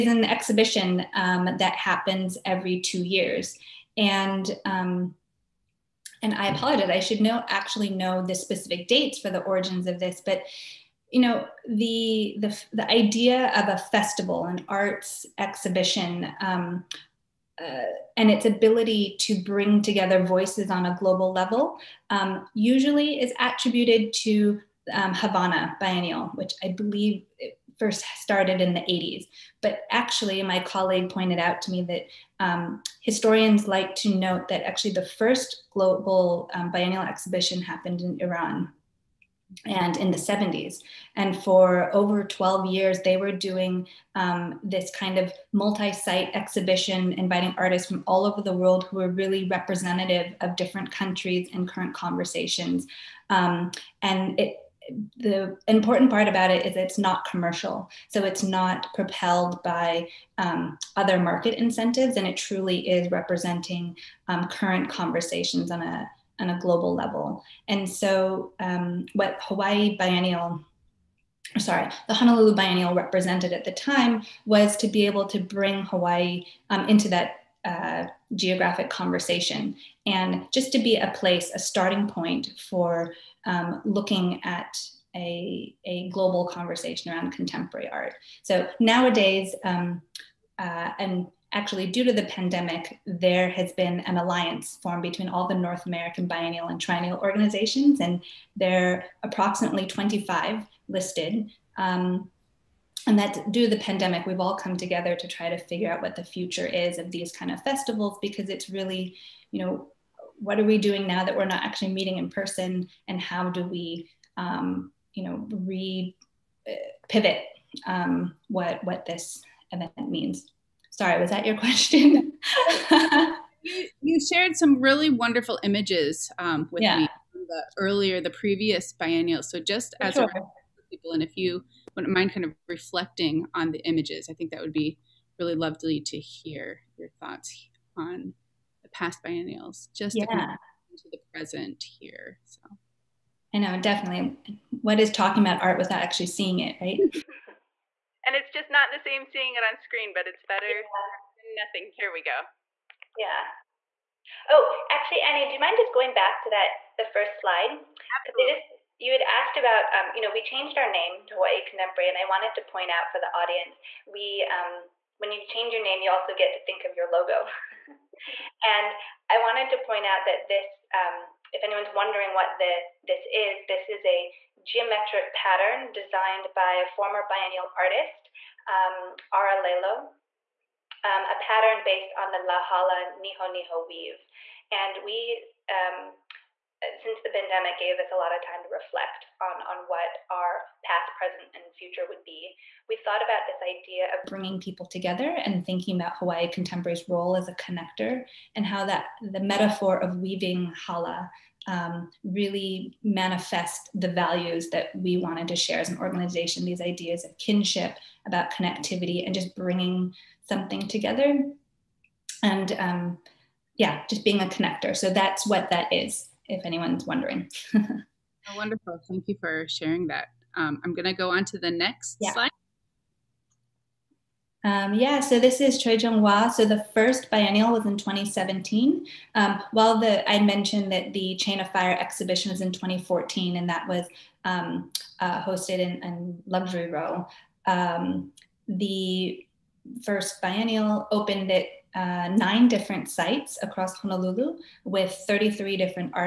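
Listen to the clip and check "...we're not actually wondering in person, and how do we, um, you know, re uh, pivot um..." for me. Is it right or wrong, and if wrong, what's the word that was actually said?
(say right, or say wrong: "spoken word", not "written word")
wrong: "meeting", not "wondering".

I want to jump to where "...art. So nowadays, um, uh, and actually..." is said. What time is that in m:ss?
1:27.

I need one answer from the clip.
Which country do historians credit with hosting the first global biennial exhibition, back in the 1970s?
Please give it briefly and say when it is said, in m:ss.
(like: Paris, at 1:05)
Iran, at 0:38.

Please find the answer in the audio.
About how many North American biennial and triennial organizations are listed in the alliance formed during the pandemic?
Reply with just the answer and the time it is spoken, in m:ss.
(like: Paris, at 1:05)
25, at 1:39.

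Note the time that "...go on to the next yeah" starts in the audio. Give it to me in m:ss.
3:41.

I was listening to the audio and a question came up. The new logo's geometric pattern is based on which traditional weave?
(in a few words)
La Hala Niho Niho.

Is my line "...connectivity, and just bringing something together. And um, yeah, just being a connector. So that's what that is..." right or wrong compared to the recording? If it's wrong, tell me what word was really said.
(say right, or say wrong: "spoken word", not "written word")
right.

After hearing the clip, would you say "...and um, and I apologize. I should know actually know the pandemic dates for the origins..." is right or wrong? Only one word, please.
wrong.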